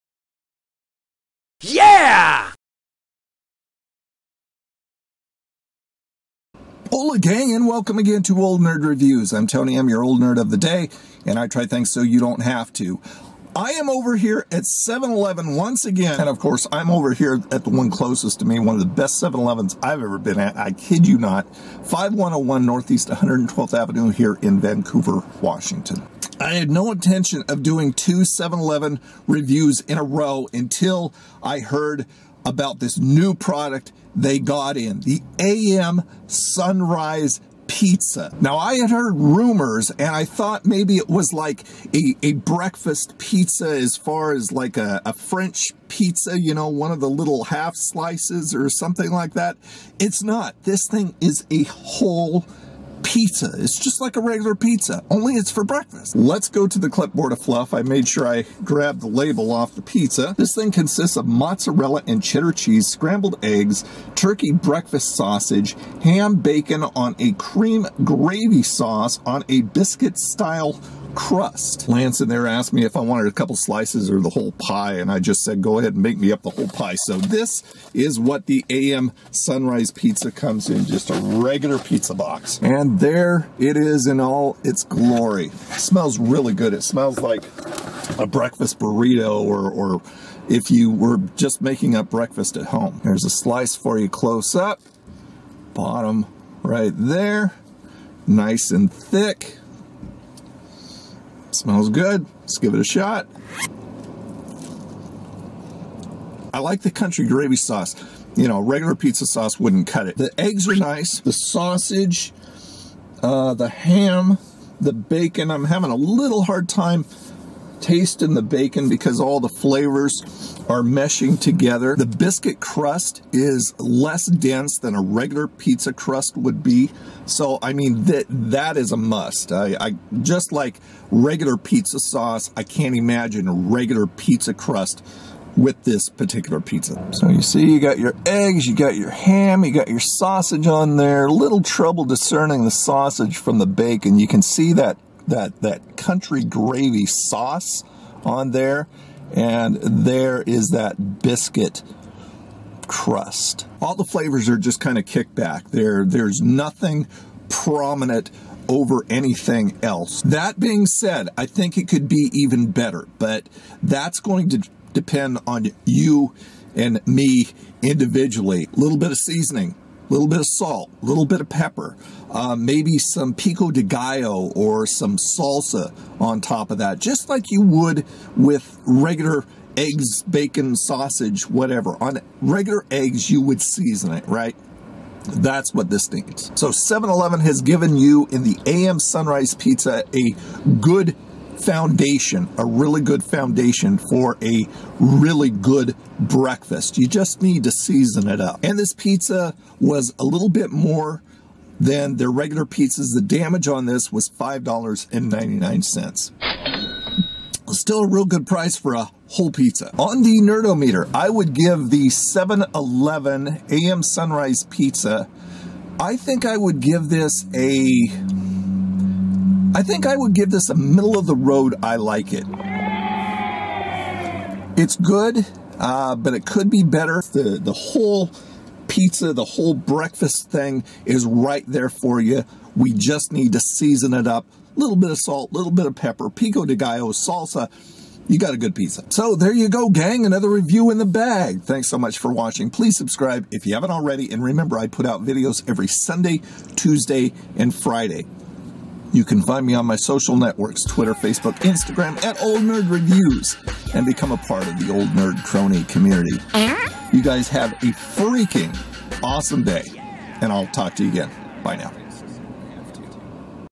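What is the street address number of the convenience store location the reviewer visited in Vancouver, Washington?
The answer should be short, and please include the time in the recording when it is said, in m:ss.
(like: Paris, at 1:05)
5101, at 0:21.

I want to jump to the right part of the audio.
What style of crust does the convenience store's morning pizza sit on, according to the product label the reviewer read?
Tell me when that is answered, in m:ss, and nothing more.
1:09.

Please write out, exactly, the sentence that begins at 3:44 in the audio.
It's good, uh, but it could be better.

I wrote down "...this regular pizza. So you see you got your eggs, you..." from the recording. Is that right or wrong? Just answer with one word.
wrong.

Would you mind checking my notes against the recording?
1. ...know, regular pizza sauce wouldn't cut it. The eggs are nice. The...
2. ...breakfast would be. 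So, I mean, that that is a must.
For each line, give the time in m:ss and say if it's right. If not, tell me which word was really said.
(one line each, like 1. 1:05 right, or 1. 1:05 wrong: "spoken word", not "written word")
1. 1:48 right
2. 2:05 wrong: "crust", not "breakfast".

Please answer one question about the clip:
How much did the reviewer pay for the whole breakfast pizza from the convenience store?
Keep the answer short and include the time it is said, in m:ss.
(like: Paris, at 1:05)
$5.99, at 3:24.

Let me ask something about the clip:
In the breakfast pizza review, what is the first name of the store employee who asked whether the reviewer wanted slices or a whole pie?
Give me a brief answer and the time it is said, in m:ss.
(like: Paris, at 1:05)
Lance, at 1:11.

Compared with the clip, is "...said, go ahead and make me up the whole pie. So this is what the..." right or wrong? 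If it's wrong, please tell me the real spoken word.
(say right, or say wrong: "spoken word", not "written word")
right.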